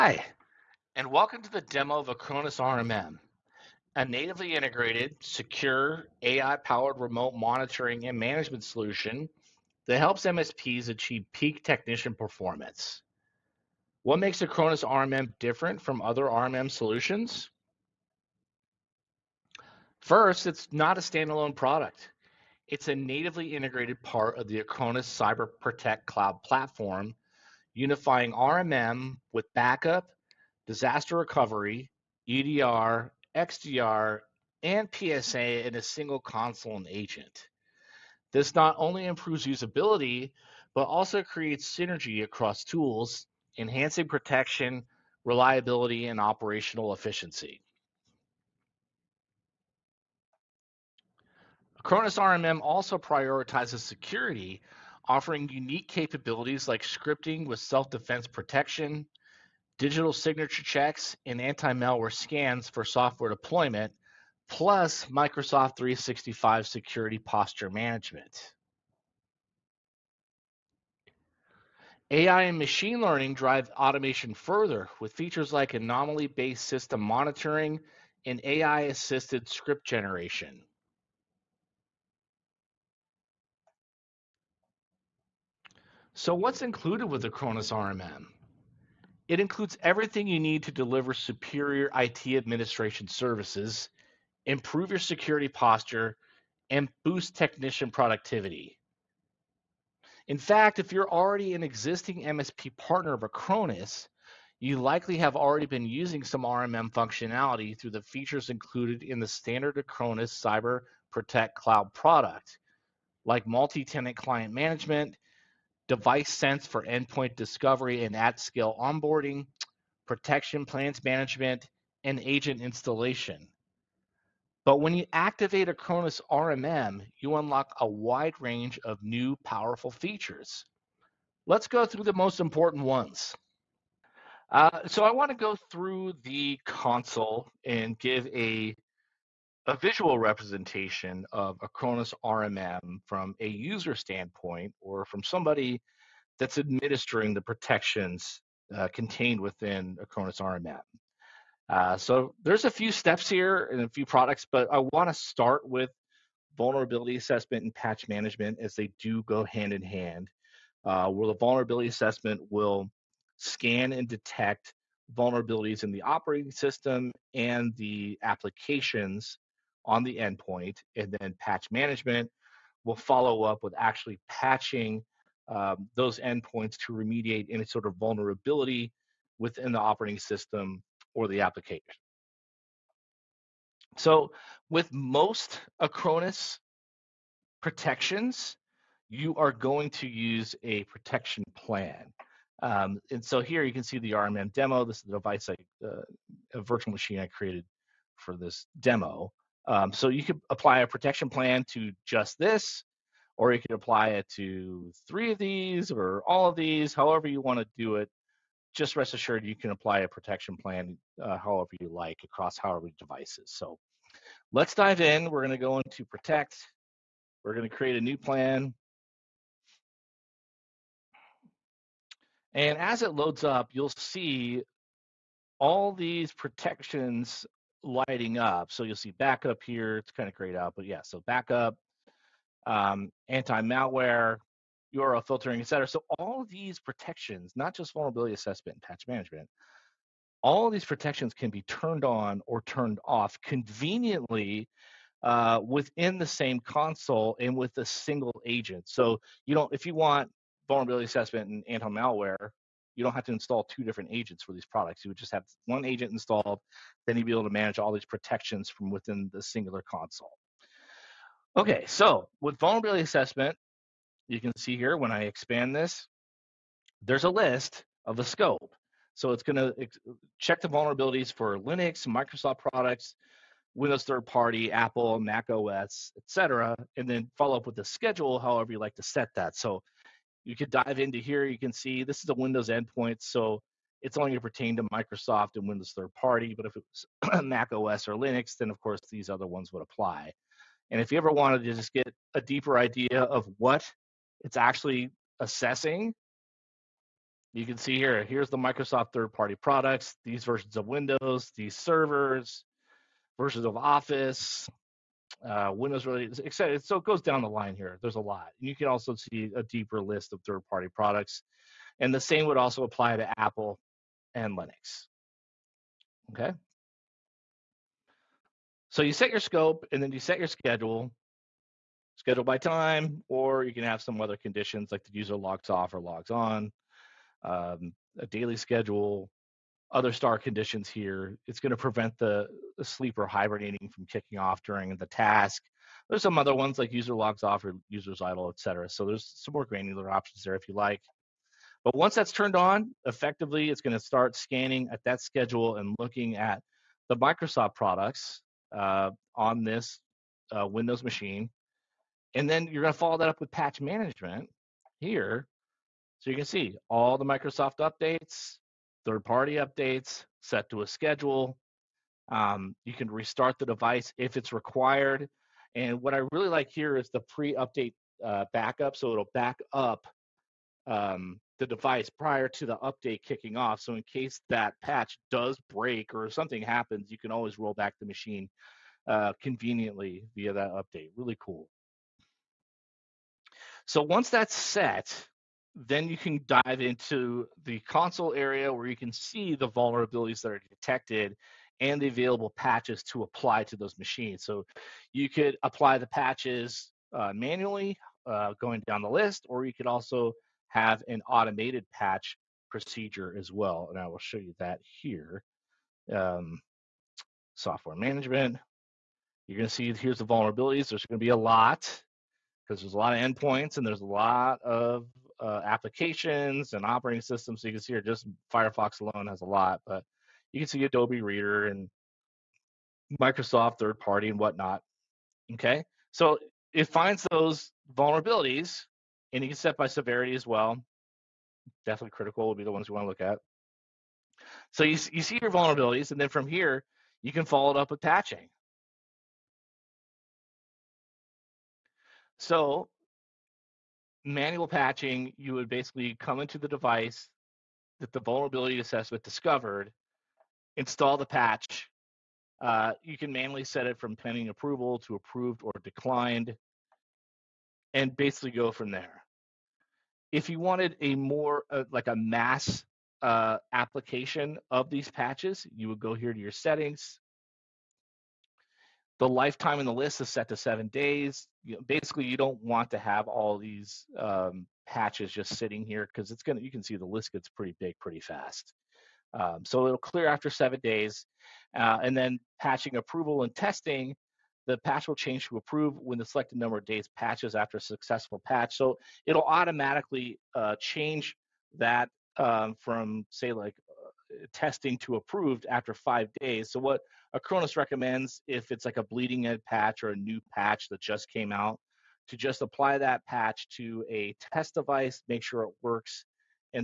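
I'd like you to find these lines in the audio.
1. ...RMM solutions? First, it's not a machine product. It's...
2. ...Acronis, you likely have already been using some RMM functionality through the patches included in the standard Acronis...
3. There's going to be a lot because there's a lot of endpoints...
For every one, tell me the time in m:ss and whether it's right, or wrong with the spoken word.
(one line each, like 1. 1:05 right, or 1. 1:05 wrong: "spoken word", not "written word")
1. 0:16 wrong: "standalone", not "machine"
2. 1:43 wrong: "features", not "patches"
3. 6:50 right.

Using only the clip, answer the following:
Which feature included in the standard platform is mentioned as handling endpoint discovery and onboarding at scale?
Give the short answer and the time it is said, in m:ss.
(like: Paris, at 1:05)
device sense, at 1:55.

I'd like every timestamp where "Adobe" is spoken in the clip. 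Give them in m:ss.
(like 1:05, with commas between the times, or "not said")
7:00.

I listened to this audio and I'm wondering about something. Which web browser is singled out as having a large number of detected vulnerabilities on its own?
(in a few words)
Firefox.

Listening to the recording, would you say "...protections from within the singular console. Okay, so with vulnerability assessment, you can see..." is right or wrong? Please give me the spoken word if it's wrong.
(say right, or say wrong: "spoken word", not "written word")
right.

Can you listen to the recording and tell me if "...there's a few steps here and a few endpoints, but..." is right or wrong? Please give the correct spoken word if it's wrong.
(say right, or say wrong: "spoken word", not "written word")
wrong: "products", not "endpoints".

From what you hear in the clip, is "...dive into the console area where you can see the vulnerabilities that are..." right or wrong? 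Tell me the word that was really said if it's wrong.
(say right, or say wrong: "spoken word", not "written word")
right.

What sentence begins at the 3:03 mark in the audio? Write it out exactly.
So, with most Acronis protections, you are going to use a protection plan.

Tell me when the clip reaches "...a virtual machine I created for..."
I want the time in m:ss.
3:16.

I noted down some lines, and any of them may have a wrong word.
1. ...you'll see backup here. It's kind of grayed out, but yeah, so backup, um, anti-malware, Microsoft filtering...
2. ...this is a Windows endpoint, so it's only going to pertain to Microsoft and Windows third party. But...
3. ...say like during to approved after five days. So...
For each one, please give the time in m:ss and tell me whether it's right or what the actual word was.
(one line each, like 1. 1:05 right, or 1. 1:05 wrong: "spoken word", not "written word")
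1. 3:48 wrong: "URL", not "Microsoft"
2. 4:42 right
3. 8:13 wrong: "testing", not "during".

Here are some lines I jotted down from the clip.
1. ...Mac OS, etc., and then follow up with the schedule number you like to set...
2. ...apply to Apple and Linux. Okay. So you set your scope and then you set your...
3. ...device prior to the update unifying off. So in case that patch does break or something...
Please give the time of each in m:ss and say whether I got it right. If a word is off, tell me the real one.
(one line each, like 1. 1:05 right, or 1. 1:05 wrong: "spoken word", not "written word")
1. 4:35 wrong: "however", not "number"
2. 5:12 right
3. 6:11 wrong: "kicking", not "unifying".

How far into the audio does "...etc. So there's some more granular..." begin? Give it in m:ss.
5:38.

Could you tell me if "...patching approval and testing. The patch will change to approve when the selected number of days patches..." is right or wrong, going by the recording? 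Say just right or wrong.
right.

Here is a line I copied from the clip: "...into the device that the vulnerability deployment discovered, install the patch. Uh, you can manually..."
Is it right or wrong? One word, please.
wrong.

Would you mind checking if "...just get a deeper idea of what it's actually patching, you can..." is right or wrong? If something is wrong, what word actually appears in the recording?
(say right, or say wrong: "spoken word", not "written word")
wrong: "assessing", not "patching".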